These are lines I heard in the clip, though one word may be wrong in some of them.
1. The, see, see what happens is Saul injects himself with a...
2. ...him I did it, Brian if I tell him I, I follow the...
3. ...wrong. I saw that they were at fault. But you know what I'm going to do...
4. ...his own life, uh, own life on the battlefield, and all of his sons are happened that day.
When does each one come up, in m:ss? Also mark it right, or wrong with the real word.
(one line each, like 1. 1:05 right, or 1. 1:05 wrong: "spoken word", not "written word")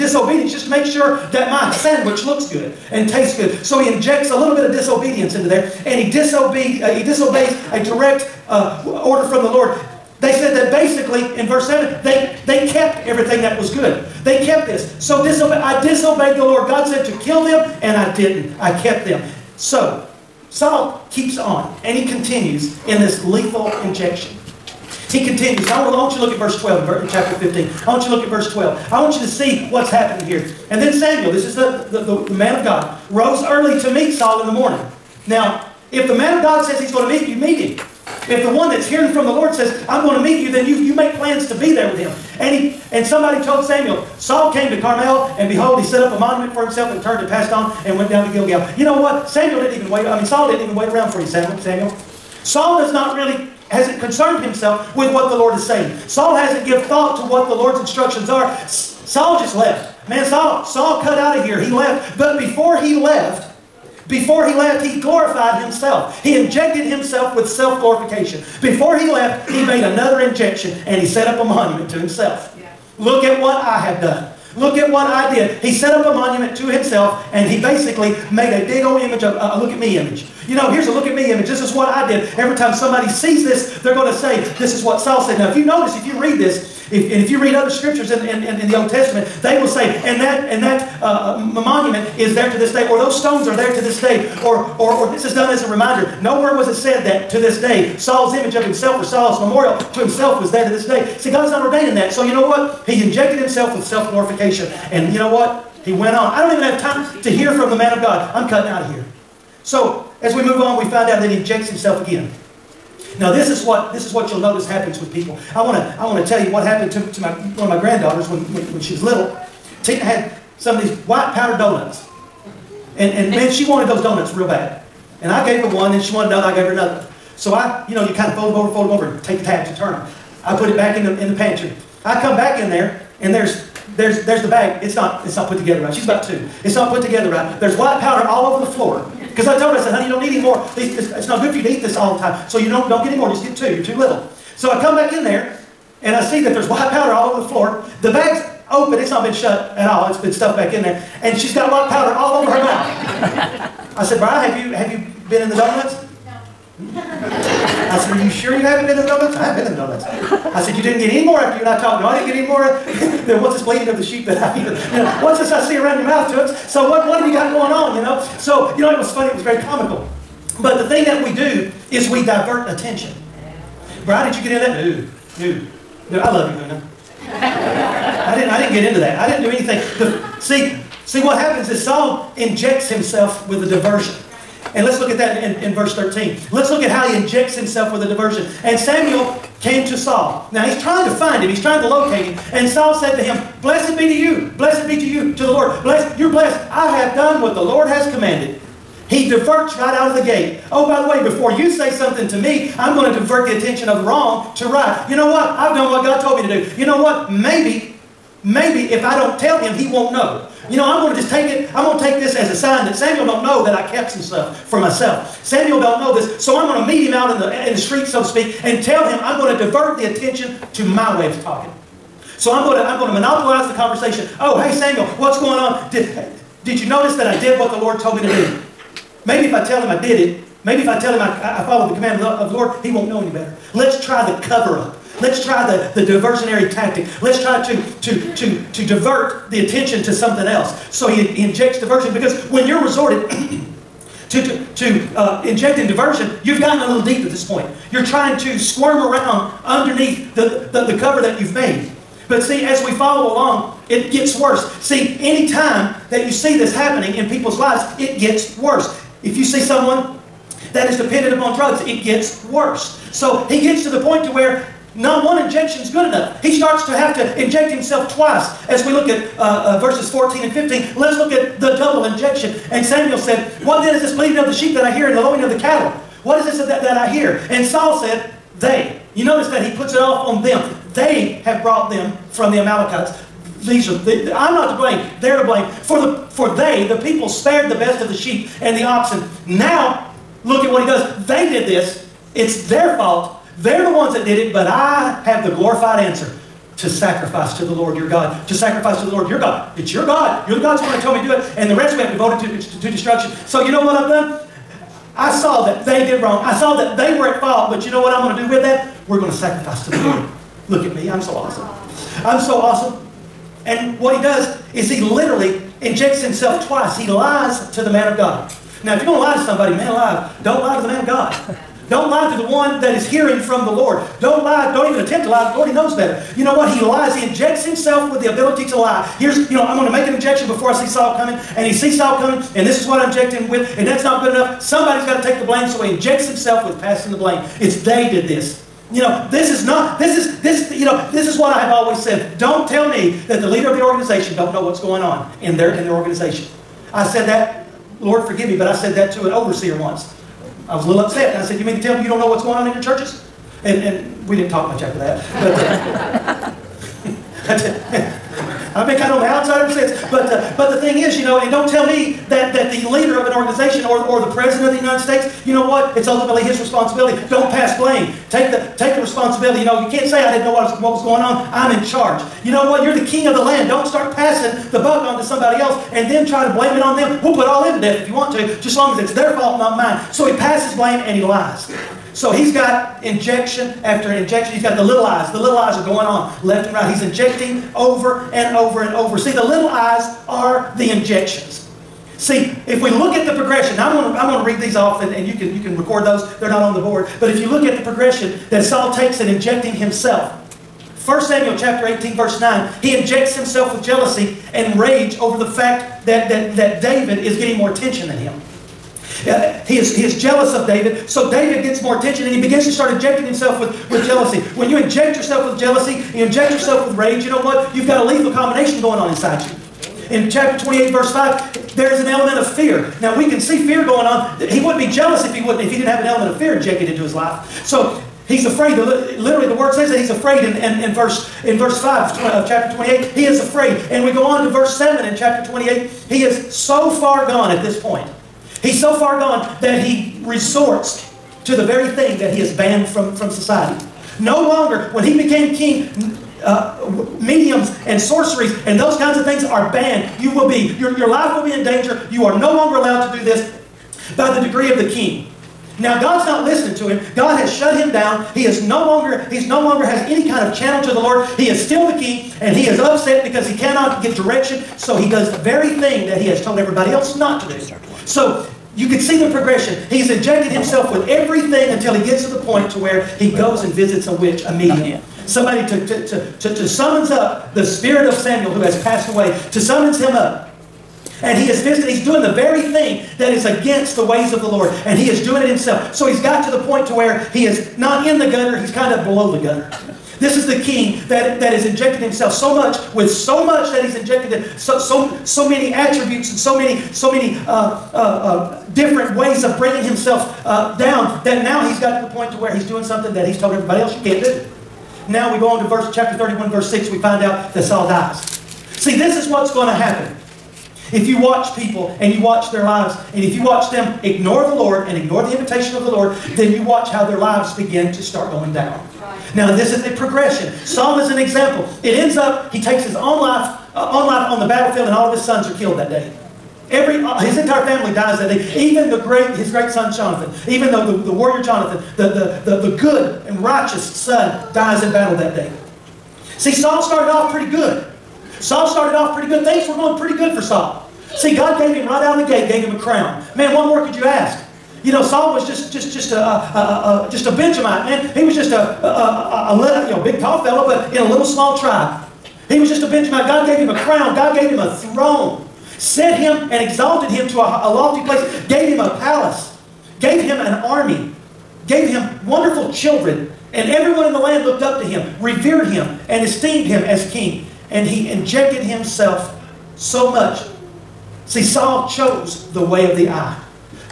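1. 2:59 right
2. 3:49 wrong: "Maybe", not "Brian"
3. 5:06 right
4. 8:42 wrong: "killed", not "happened".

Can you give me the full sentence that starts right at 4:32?
And Samuel said, What then is this bleating of the sheep that I hear and the lowing of the cattle?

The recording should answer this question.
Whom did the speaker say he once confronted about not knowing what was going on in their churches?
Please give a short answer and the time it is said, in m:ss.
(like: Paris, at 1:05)
an overseer, at 5:49.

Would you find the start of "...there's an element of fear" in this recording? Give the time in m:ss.
7:01.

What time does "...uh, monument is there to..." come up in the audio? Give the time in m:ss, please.
1:31.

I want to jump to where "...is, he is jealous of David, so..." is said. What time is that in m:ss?
6:49.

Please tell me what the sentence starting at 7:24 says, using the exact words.
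No longer, when he became king, uh, mediums and sorceries and those kinds of things are banned.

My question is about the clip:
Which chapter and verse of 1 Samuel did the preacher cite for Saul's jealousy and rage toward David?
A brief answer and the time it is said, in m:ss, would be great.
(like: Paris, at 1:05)
chapter 18, verse 9, at 6:41.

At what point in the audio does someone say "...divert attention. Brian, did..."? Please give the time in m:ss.
2:52.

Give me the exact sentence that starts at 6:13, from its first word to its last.
Don't start passing the buck on to somebody else and then try to blame it on them.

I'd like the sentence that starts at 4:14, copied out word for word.
See, any time that you see this happening in people's lives, it gets worse.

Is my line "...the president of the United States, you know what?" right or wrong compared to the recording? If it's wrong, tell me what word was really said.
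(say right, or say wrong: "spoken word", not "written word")
right.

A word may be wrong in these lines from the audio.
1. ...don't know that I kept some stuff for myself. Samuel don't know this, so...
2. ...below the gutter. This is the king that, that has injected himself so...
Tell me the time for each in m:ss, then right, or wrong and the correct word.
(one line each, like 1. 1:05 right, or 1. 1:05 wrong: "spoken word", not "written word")
1. 3:33 right
2. 8:09 right.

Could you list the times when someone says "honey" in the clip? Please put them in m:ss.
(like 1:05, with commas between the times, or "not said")
2:19.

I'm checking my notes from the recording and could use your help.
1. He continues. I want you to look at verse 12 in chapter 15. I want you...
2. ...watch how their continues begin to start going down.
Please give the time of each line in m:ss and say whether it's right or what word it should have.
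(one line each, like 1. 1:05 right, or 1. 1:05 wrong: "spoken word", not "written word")
1. 0:25 right
2. 8:36 wrong: "lives", not "continues".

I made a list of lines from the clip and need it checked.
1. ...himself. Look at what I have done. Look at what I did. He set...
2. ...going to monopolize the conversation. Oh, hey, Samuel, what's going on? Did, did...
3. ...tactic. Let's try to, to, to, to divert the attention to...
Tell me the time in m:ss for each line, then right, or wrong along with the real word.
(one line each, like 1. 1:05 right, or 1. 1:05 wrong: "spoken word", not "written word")
1. 1:11 right
2. 3:42 right
3. 3:56 right.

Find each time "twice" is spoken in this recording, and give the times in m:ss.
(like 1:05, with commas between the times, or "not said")
4:28, 5:16.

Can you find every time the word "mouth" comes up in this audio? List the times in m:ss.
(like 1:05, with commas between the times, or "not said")
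2:32, 2:46.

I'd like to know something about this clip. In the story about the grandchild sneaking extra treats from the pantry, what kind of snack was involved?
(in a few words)
white powdered donuts.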